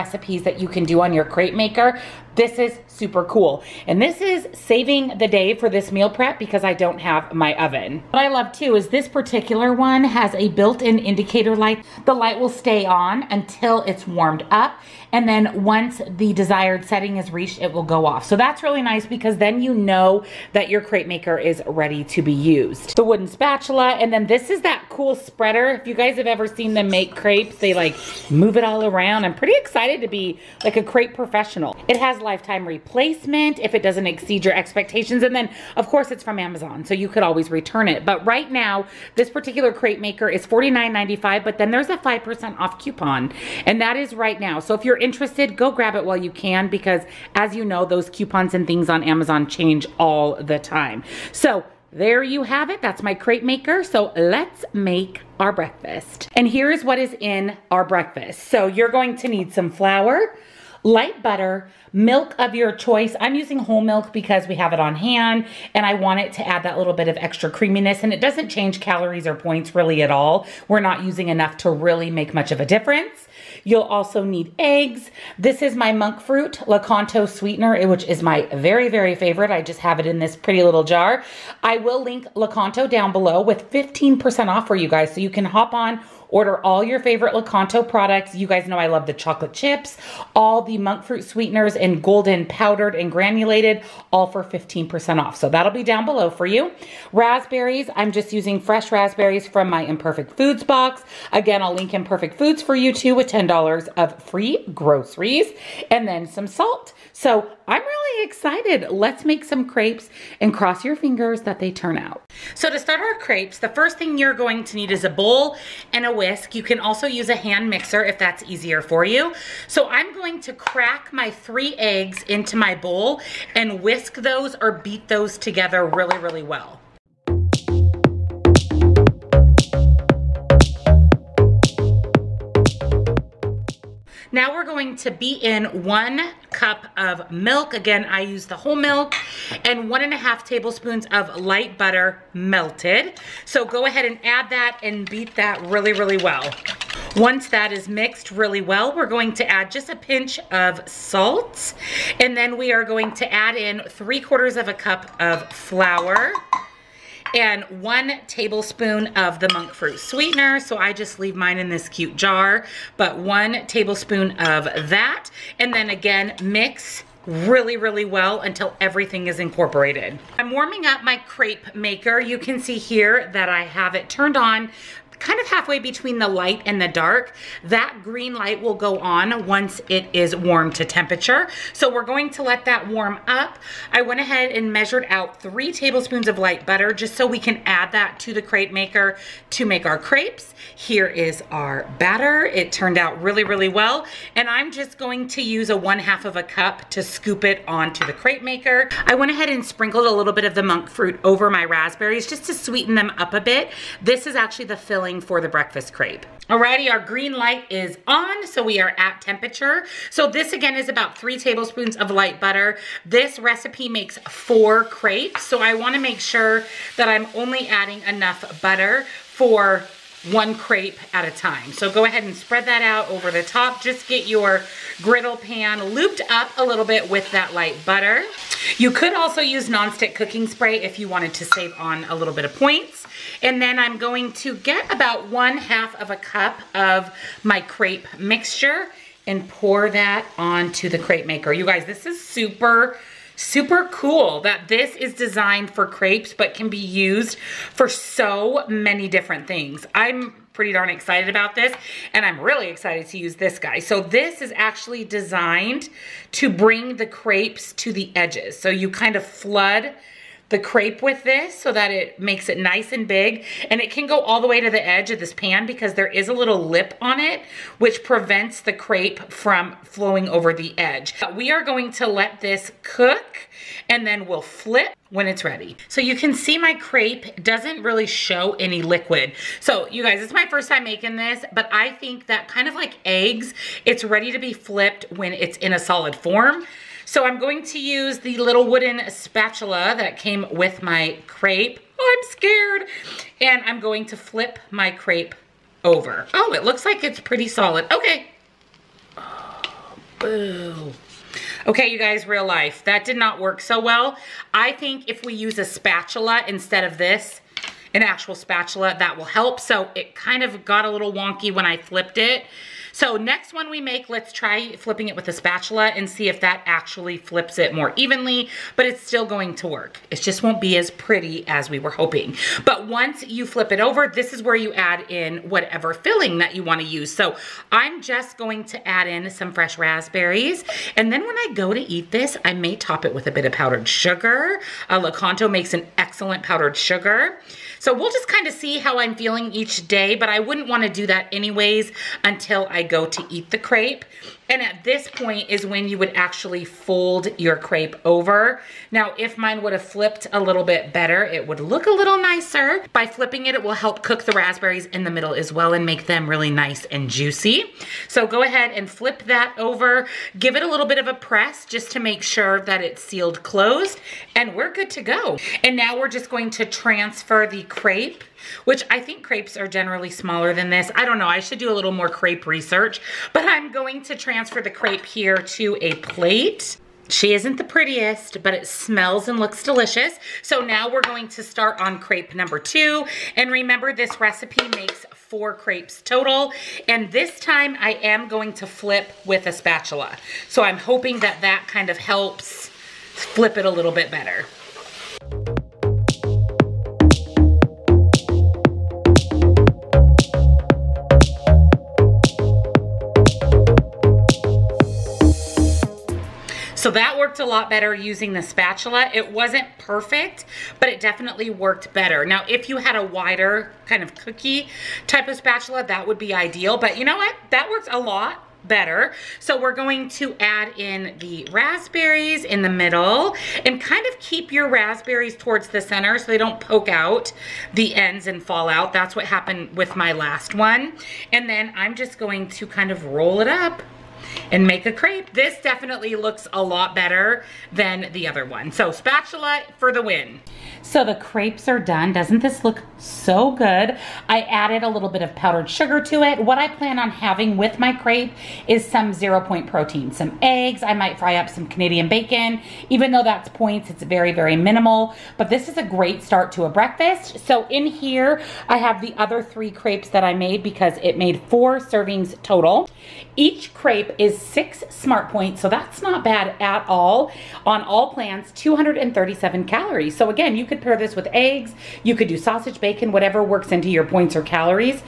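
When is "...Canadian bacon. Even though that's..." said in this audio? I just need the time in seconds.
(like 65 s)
451 s.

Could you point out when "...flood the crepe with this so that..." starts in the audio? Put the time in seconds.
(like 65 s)
259 s.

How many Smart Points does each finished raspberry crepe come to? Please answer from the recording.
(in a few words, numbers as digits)
6.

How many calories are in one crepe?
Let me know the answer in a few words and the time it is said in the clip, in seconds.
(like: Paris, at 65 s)
237, at 468 s.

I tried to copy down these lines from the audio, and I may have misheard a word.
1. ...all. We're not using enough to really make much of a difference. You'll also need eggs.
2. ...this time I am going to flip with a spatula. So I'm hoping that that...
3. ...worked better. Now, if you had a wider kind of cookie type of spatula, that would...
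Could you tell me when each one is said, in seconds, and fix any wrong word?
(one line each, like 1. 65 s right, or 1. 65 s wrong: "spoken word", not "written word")
1. 70 s right
2. 387 s right
3. 411 s right.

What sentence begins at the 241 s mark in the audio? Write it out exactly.
You guys, this is super Super cool that this is designed for crepes but can be used for so many different things.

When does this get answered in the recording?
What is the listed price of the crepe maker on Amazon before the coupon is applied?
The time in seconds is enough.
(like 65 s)
40 s.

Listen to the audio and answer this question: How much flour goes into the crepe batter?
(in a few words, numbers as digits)
3/4 cup.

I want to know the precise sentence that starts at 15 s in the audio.
And then once the desired setting is reached, it will go off.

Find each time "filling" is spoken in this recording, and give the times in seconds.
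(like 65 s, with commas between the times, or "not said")
204 s, 325 s.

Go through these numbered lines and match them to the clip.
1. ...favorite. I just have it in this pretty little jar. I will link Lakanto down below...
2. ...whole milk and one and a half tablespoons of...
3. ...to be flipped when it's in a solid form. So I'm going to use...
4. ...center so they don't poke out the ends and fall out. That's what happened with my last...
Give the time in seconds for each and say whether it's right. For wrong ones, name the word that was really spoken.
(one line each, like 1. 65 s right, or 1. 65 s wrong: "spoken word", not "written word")
1. 79 s right
2. 138 s right
3. 284 s right
4. 425 s right.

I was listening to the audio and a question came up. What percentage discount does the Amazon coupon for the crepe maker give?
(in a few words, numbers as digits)
5%.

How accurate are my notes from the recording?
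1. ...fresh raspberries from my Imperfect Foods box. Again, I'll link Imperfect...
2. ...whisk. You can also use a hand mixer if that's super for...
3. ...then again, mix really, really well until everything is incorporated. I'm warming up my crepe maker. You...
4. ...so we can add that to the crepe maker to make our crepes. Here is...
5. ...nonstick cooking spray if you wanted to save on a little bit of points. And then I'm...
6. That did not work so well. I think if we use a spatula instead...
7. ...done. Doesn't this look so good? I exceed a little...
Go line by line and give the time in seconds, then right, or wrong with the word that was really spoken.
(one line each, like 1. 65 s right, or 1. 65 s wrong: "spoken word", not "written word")
1. 98 s right
2. 116 s wrong: "easier", not "super"
3. 165 s right
4. 187 s right
5. 229 s right
6. 302 s right
7. 441 s wrong: "added", not "exceed".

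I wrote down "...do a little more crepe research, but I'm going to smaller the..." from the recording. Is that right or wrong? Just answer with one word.
wrong.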